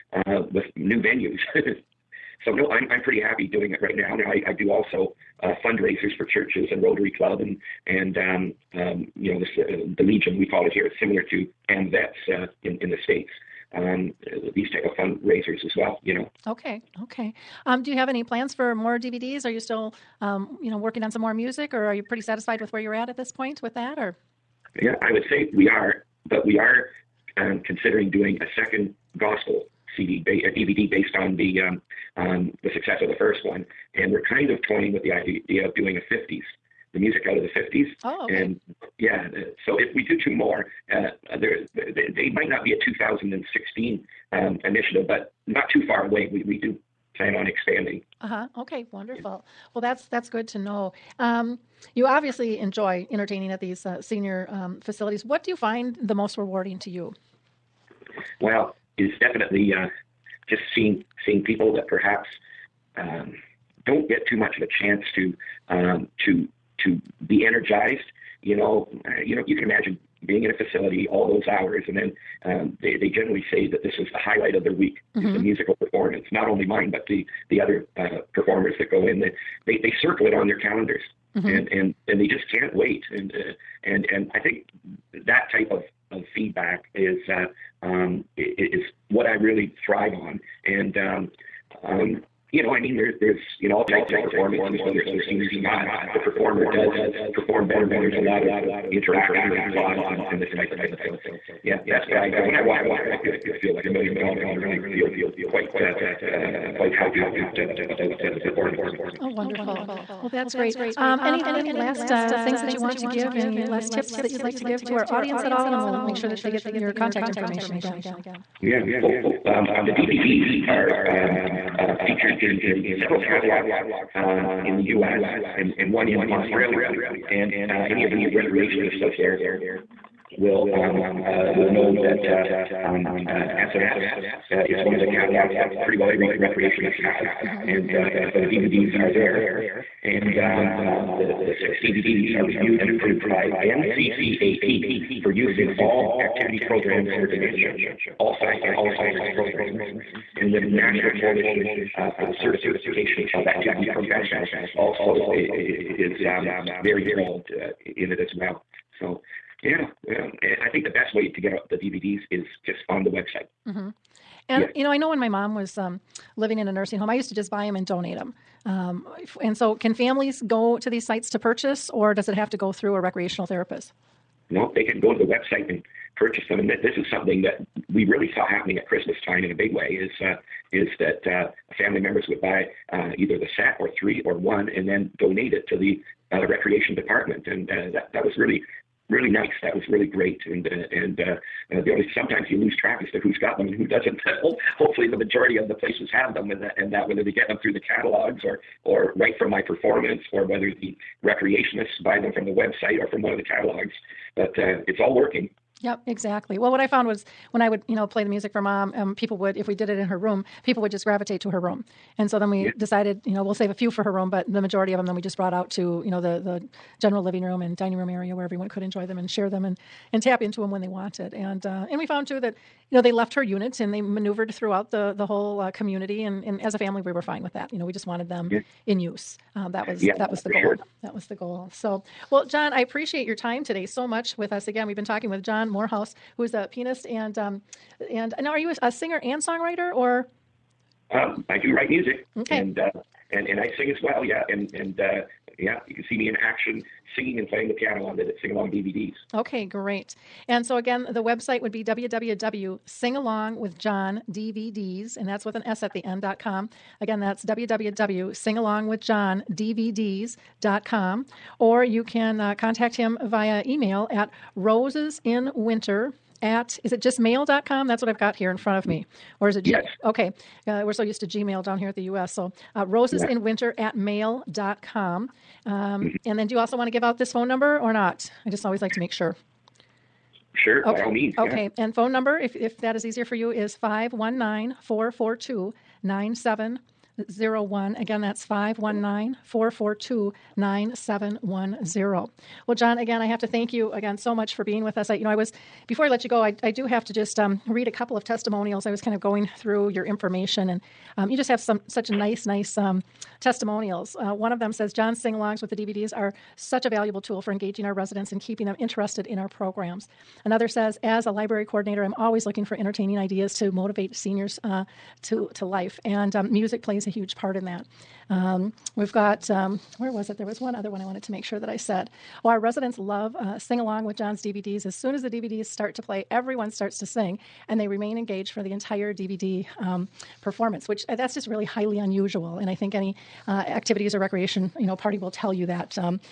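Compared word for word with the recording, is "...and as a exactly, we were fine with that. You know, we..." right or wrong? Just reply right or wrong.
wrong.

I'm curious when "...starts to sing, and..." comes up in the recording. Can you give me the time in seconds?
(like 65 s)
326 s.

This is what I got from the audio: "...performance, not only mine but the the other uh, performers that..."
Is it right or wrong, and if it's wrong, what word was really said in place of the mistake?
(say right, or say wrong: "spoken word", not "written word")
right.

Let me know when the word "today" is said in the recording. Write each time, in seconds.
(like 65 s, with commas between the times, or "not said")
233 s.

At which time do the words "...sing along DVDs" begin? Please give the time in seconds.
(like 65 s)
248 s.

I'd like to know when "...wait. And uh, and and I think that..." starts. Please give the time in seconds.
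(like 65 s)
82 s.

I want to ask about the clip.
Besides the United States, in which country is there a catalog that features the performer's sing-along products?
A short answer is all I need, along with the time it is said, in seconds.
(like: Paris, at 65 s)
Australia, at 126 s.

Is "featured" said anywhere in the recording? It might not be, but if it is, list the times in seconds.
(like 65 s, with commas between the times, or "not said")
122 s.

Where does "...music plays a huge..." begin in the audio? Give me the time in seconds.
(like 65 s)
316 s.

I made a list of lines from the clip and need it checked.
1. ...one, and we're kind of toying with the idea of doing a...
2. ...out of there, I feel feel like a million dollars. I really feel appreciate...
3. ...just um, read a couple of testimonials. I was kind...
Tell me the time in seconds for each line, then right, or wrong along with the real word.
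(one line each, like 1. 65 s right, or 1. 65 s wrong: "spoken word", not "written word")
1. 33 s right
2. 102 s wrong: "quite", not "appreciate"
3. 297 s right.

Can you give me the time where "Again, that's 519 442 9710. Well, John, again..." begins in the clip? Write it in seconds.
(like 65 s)
287 s.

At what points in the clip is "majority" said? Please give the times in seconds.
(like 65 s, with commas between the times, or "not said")
195 s, 214 s.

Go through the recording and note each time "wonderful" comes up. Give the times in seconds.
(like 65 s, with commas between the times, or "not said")
48 s, 109 s.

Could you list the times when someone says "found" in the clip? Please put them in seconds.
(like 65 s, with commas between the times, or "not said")
206 s, 222 s.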